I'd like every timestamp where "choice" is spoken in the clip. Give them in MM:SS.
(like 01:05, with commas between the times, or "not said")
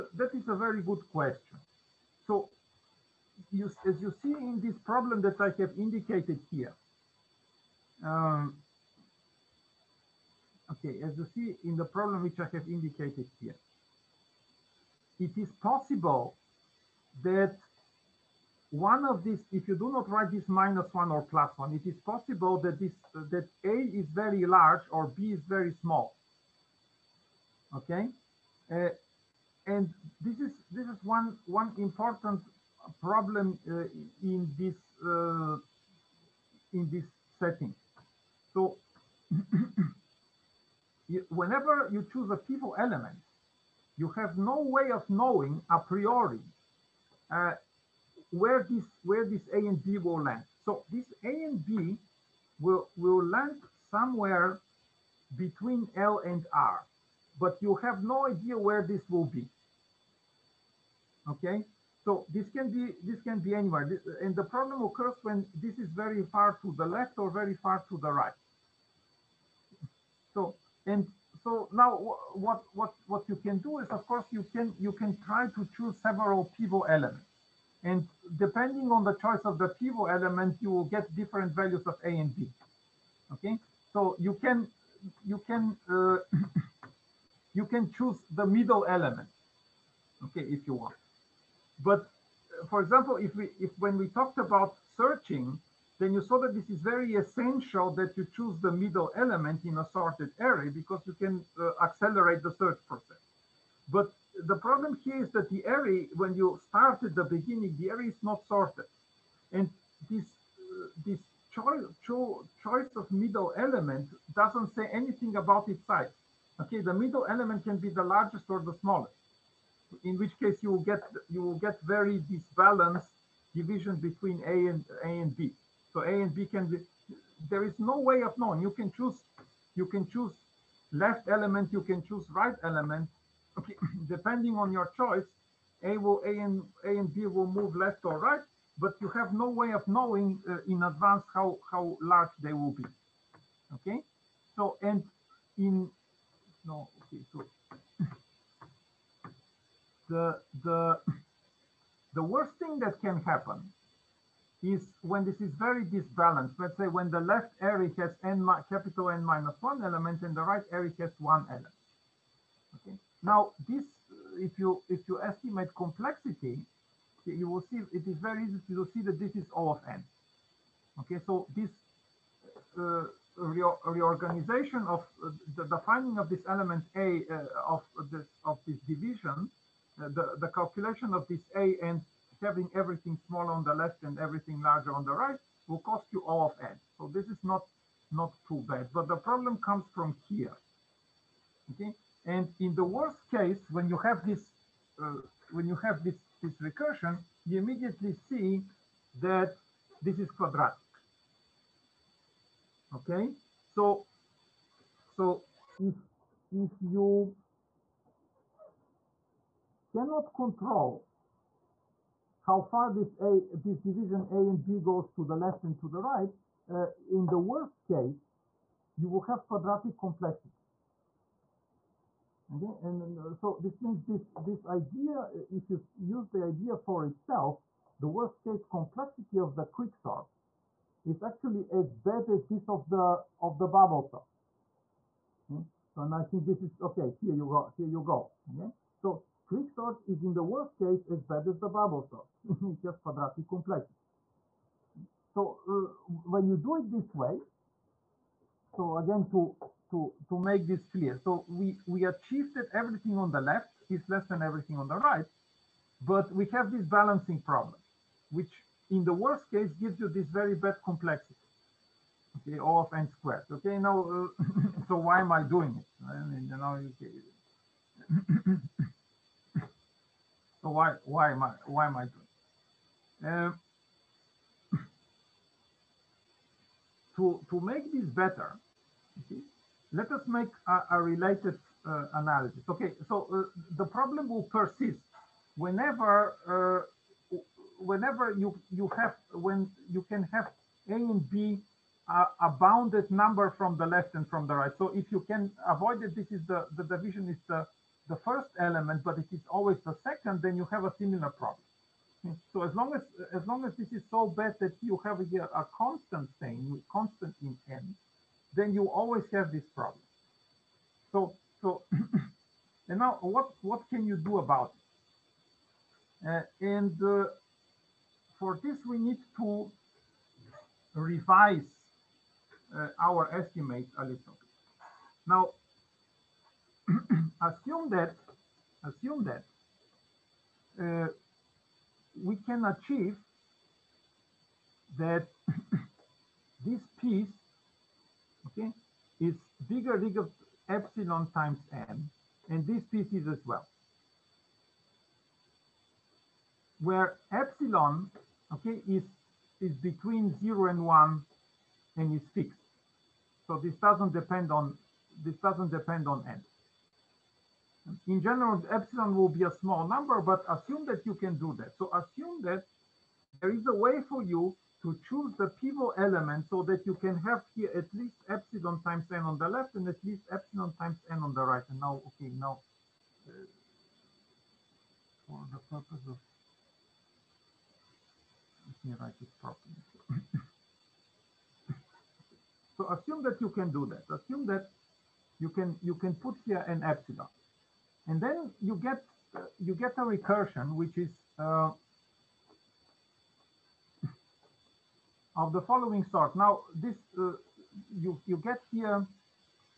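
01:19, 01:52, 02:14.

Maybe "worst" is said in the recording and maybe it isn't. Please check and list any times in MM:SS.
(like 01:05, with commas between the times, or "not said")
02:32, 03:12, 03:37, 03:48, 04:00, 04:19.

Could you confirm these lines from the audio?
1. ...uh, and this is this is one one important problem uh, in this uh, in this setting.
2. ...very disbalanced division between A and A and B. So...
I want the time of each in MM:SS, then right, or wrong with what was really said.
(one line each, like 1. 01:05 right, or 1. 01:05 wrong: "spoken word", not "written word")
1. 00:28 right
2. 02:01 right.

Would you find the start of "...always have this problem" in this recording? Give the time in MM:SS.
05:08.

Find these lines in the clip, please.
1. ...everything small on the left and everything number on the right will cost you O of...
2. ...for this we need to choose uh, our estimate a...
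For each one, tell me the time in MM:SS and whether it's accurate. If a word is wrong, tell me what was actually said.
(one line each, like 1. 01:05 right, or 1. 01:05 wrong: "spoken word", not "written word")
1. 03:02 wrong: "larger", not "number"
2. 05:18 wrong: "revise", not "choose".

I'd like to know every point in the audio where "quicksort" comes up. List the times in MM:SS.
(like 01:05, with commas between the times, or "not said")
03:49, 03:59.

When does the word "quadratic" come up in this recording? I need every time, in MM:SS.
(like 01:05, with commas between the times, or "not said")
03:20, 03:39, 04:03.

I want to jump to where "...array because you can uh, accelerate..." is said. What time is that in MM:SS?
01:40.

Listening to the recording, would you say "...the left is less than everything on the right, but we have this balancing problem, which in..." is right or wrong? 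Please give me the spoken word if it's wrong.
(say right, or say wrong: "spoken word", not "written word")
right.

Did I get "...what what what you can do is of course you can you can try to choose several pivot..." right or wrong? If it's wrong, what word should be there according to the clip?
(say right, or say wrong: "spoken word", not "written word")
right.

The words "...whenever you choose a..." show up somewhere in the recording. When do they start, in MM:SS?
00:41.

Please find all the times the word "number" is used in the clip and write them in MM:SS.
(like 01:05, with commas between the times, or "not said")
04:53, 05:59.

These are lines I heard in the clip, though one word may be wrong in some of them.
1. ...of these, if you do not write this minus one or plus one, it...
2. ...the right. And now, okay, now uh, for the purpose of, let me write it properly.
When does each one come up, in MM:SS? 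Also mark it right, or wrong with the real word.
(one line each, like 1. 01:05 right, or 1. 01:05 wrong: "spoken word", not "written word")
1. 00:19 right
2. 06:11 right.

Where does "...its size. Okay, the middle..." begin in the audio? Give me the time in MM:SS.
01:55.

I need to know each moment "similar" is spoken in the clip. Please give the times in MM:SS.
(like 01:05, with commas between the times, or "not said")
05:00.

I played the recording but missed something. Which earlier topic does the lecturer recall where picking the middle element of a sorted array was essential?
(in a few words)
searching.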